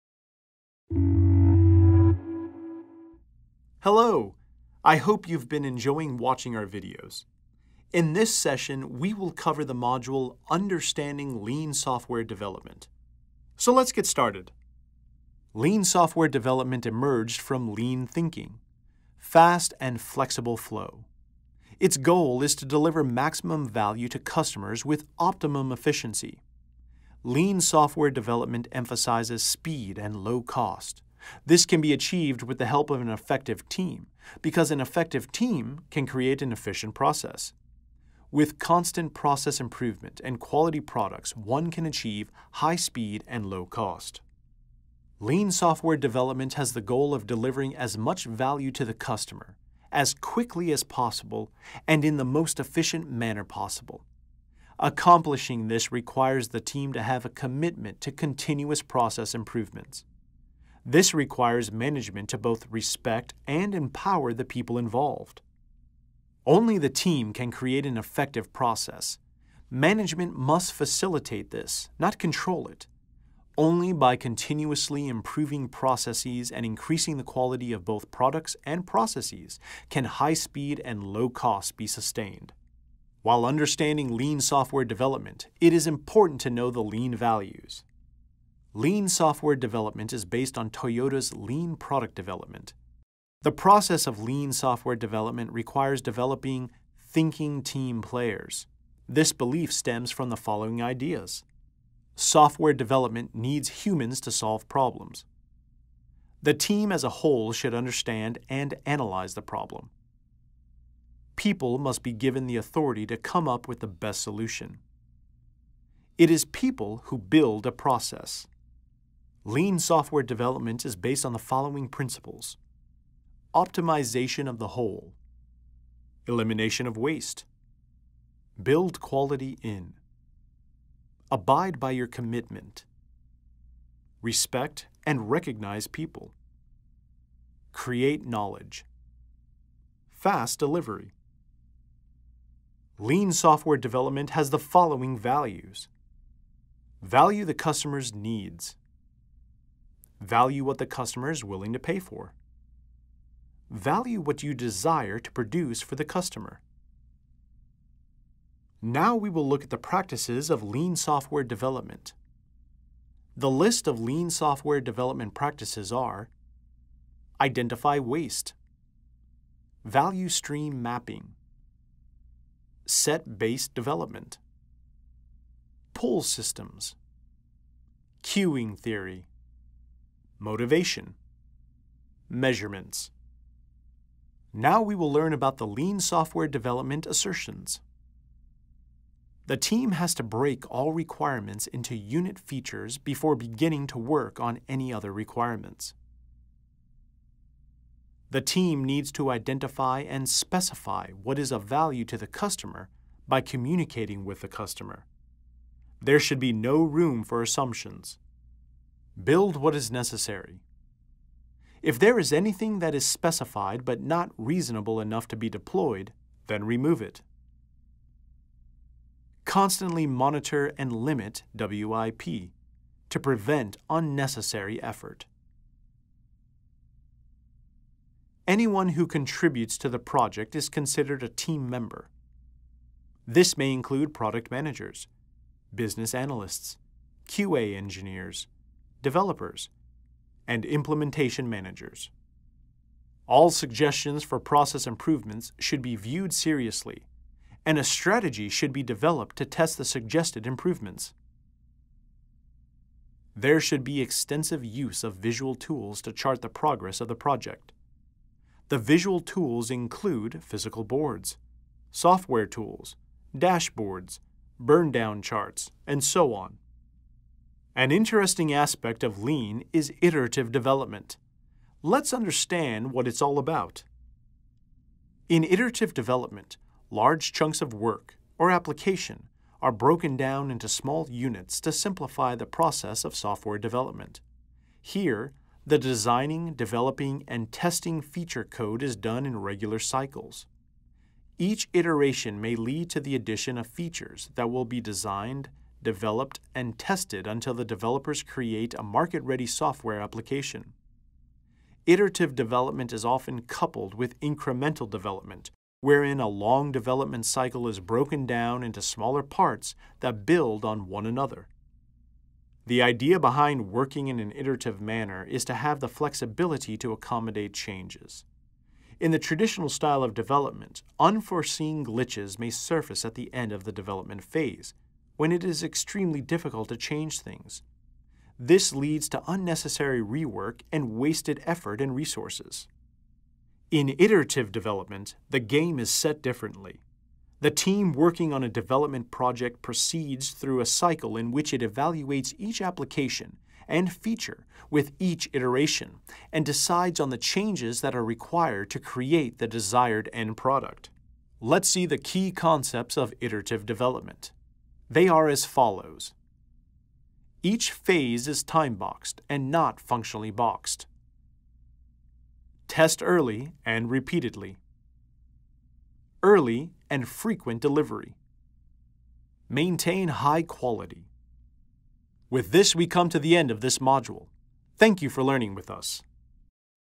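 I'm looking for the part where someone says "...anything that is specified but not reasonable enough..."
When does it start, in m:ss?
3:32.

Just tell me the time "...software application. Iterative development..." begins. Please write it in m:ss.
4:59.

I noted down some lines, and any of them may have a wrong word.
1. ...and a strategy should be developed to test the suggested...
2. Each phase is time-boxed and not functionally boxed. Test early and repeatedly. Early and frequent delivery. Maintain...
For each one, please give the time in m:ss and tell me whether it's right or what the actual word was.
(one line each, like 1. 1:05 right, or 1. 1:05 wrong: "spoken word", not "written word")
1. 4:07 right
2. 5:57 right.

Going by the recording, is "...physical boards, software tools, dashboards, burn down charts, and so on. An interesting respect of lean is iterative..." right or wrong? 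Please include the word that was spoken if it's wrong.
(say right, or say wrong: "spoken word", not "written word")
wrong: "aspect", not "respect".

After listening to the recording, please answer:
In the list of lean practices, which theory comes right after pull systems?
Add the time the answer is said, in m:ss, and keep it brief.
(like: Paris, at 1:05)
Queuing theory, at 2:58.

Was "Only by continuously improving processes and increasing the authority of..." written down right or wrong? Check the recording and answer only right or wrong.
wrong.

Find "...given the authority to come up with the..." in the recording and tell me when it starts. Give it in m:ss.
1:52.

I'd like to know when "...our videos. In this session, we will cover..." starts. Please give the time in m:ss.
0:06.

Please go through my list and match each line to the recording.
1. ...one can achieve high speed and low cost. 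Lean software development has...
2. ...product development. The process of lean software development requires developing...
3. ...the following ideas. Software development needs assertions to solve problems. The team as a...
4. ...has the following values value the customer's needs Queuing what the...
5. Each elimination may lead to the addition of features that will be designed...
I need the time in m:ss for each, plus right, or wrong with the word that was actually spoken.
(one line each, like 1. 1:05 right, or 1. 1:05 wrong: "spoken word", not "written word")
1. 0:41 right
2. 1:31 right
3. 1:40 wrong: "humans", not "assertions"
4. 2:24 wrong: "Value", not "Queuing"
5. 4:51 wrong: "iteration", not "elimination".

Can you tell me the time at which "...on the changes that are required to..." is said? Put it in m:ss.
5:46.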